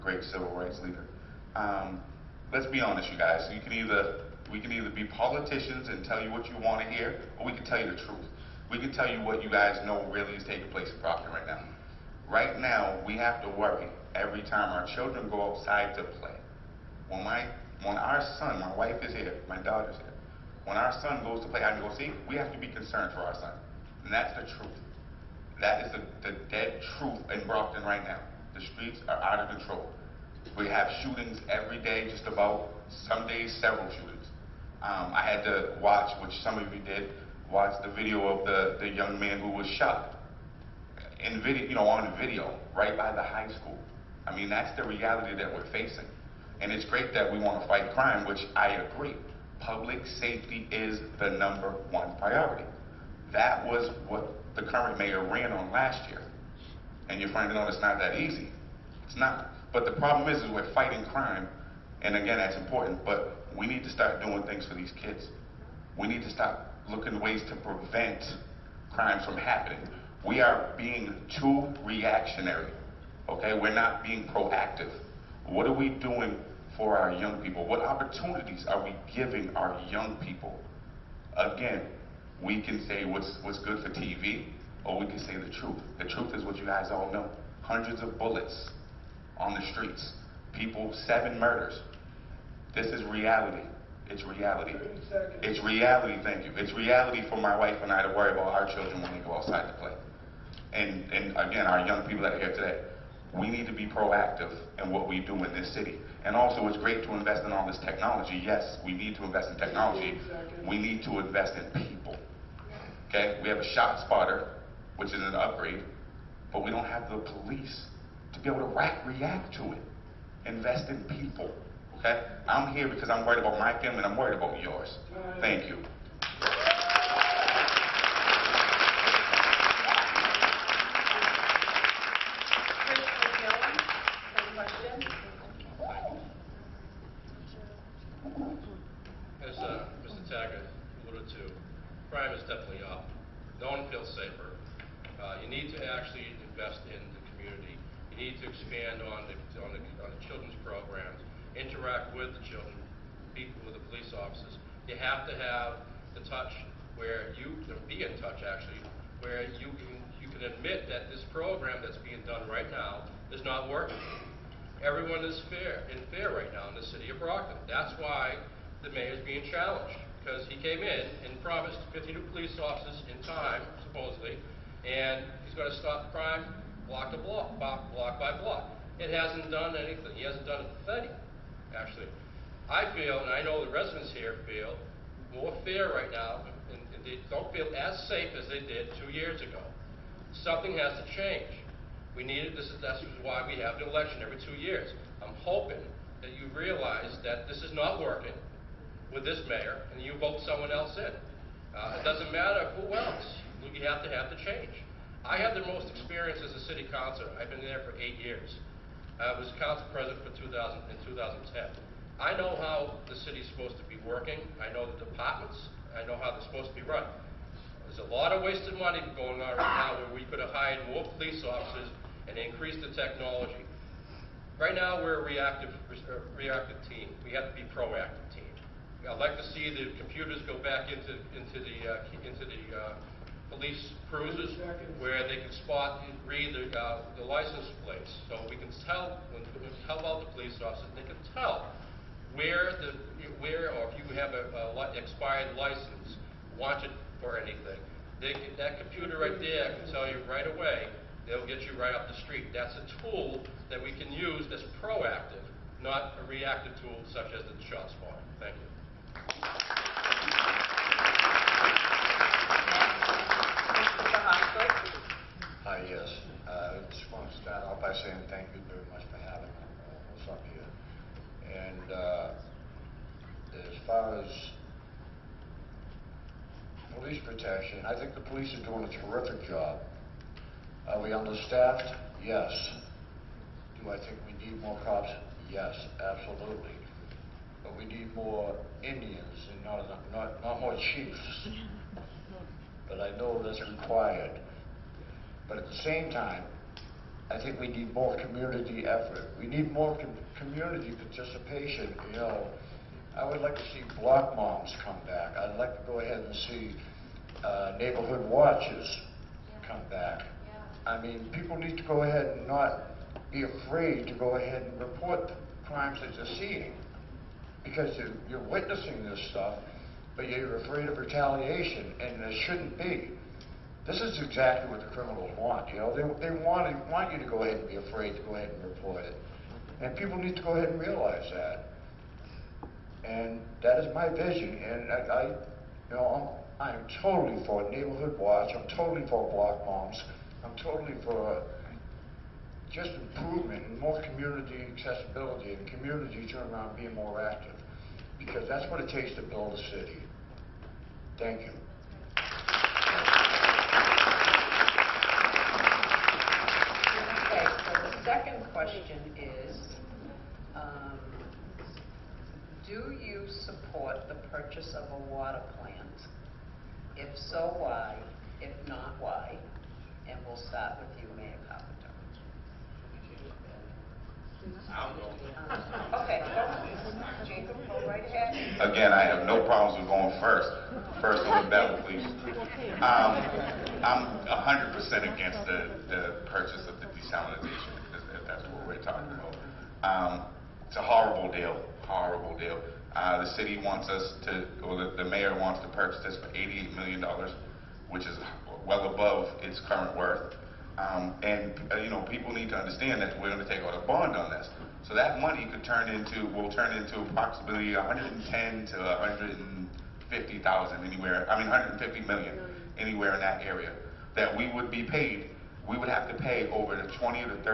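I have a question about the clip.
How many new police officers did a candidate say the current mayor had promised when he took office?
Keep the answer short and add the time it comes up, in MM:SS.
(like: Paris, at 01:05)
50, at 02:51.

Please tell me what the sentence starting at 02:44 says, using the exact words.
Everyone is fair in fair right now in the city of Brockton.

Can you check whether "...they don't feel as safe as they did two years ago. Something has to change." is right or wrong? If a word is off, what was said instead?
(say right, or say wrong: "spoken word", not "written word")
right.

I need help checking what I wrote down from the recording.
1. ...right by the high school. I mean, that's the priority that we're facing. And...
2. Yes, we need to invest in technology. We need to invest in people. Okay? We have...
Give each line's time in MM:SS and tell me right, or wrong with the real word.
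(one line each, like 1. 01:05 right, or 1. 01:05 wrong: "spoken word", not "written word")
1. 00:42 wrong: "reality", not "priority"
2. 01:48 right.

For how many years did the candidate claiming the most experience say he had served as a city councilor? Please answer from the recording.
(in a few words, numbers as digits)
8.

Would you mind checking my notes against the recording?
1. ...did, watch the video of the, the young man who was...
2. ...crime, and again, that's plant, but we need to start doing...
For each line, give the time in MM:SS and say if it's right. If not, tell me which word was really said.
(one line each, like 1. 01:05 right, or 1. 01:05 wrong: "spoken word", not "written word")
1. 00:36 right
2. 01:01 wrong: "important", not "plant".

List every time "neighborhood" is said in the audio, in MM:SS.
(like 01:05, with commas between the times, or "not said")
05:07, 05:37.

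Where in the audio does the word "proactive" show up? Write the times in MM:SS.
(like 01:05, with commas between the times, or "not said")
01:14, 01:43, 03:47, 04:14.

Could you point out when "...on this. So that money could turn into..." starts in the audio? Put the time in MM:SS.
06:44.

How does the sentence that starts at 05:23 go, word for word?
This is exactly what the criminals want.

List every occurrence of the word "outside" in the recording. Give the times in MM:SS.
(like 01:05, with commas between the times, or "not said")
00:15, 01:39.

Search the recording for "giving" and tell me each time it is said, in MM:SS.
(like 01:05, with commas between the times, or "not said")
01:19.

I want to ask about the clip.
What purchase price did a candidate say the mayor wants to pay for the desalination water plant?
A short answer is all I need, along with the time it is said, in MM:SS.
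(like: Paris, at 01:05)
$88 million, at 06:36.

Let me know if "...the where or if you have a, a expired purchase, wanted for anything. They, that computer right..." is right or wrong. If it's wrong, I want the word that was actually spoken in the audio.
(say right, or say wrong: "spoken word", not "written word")
wrong: "license", not "purchase".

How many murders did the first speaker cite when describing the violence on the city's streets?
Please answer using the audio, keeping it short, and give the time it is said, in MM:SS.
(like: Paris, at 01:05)
7, at 01:31.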